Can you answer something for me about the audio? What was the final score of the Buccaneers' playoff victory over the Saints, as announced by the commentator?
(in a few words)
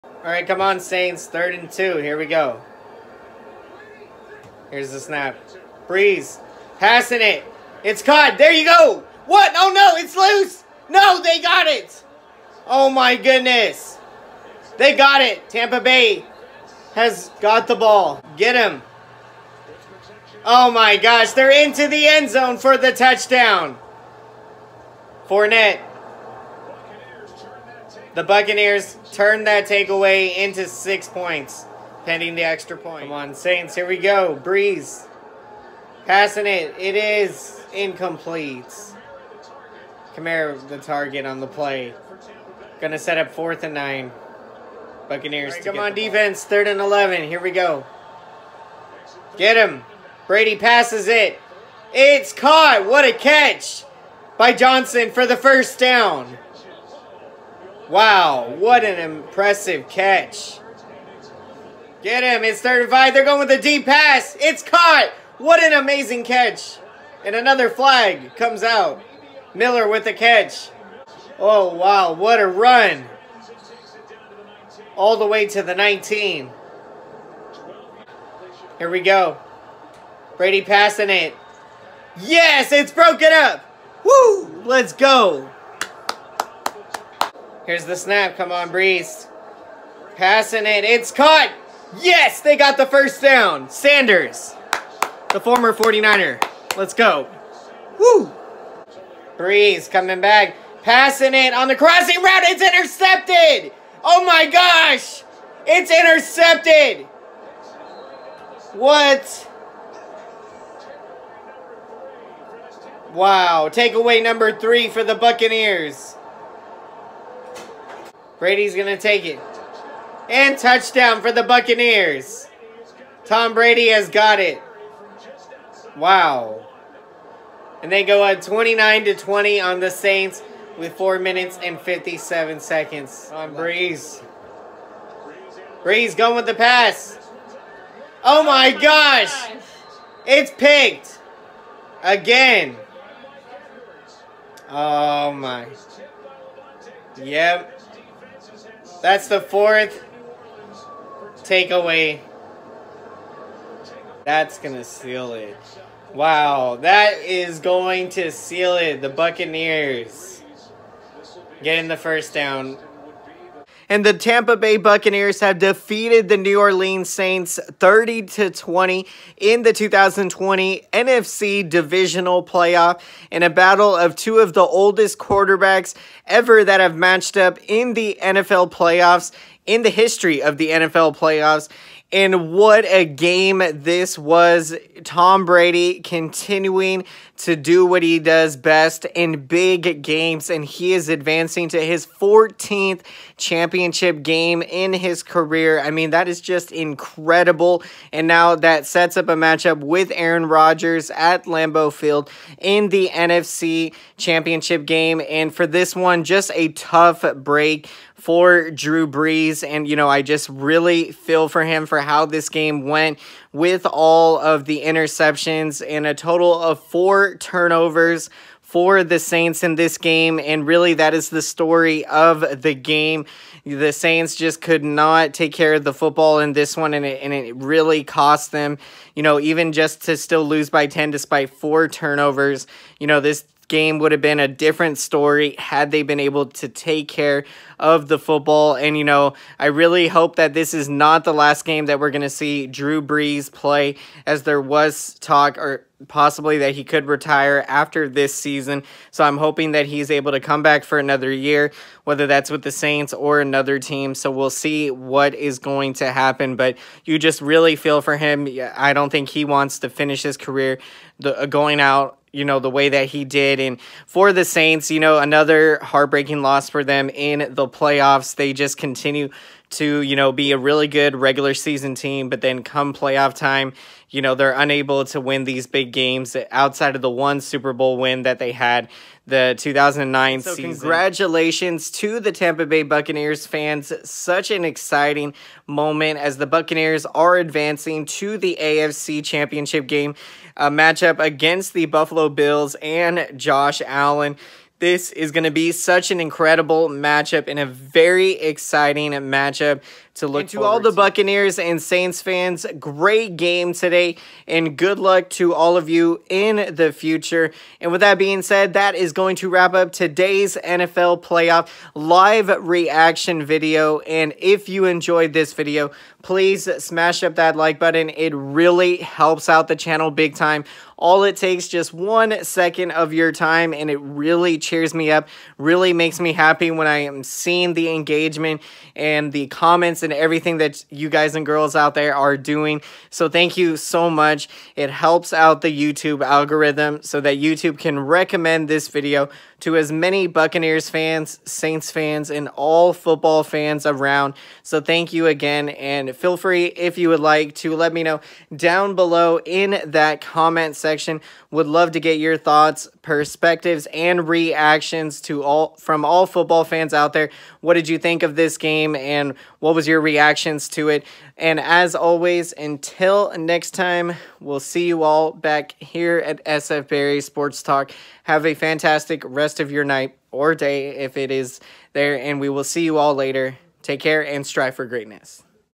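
30 to 20.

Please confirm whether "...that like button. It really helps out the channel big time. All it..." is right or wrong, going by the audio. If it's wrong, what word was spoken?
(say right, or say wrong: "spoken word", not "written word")
right.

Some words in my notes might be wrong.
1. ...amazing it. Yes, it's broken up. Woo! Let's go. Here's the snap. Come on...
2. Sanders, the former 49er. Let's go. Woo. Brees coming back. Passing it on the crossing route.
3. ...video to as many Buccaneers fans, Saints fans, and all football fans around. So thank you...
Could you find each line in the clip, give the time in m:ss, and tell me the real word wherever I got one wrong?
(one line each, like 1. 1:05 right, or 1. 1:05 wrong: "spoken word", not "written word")
1. 1:20 wrong: "passing", not "amazing"
2. 1:33 right
3. 5:38 right.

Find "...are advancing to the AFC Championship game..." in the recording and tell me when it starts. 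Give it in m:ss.
4:47.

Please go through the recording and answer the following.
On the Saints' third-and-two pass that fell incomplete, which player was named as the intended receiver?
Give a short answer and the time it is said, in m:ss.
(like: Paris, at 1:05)
Kamara, at 0:40.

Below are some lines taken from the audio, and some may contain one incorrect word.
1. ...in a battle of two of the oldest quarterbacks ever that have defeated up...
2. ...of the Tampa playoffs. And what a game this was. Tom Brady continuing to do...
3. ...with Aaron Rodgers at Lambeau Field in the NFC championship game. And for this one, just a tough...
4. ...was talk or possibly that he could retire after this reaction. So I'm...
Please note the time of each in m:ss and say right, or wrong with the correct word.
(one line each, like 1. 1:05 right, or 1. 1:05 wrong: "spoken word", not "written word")
1. 2:53 wrong: "matched", not "defeated"
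2. 3:00 wrong: "NFL", not "Tampa"
3. 3:19 right
4. 4:04 wrong: "season", not "reaction".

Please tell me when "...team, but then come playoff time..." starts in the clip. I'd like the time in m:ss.
4:31.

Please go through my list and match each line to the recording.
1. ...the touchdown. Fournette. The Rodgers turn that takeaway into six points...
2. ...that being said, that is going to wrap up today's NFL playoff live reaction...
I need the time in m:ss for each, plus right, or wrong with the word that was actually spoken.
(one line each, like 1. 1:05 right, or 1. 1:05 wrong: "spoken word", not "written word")
1. 0:22 wrong: "Buccaneers", not "Rodgers"
2. 5:08 right.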